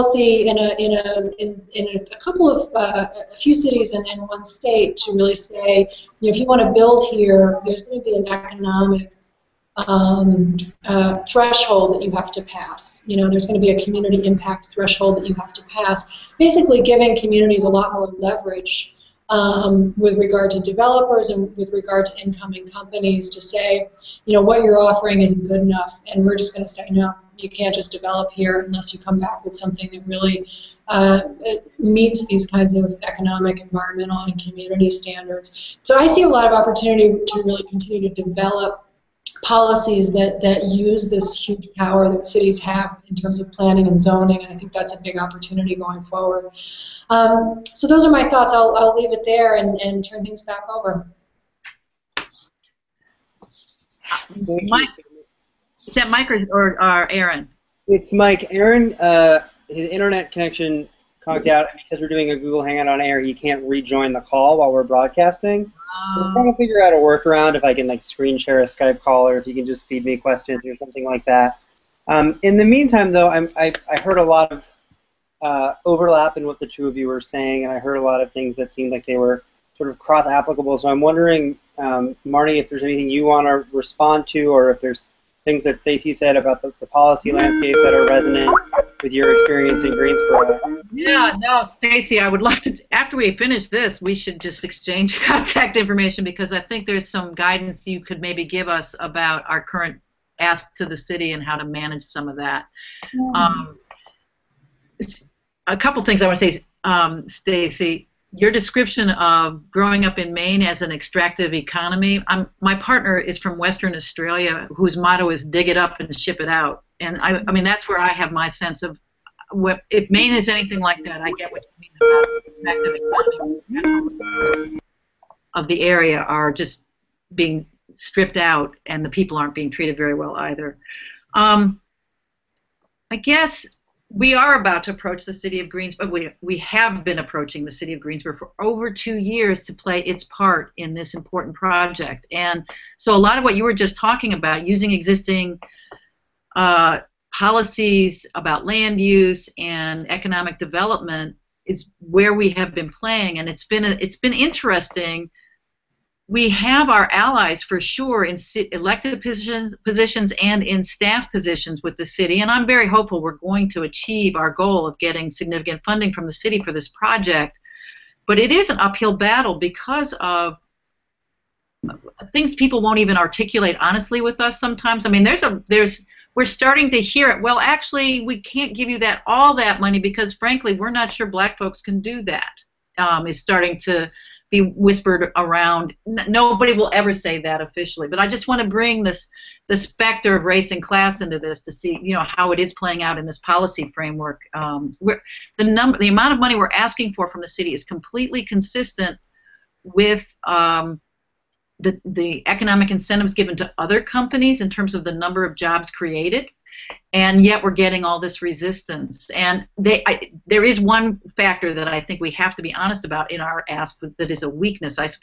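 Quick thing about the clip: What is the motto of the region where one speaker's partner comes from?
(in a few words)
Dig it up and ship it out.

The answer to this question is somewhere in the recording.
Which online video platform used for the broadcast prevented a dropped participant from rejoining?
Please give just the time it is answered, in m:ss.
1:02.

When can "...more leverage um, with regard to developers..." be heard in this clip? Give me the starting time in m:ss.
0:17.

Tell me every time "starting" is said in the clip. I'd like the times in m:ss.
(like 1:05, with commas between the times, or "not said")
2:56, 3:03.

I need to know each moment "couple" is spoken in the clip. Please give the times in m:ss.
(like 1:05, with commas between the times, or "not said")
0:02, 1:45.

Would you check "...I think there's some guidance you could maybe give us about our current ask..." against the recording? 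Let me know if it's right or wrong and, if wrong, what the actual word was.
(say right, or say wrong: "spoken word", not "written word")
right.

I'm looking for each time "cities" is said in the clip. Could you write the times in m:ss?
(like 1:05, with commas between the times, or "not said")
0:03, 0:42.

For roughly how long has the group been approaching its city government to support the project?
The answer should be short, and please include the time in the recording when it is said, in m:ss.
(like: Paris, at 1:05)
over 2 years, at 2:18.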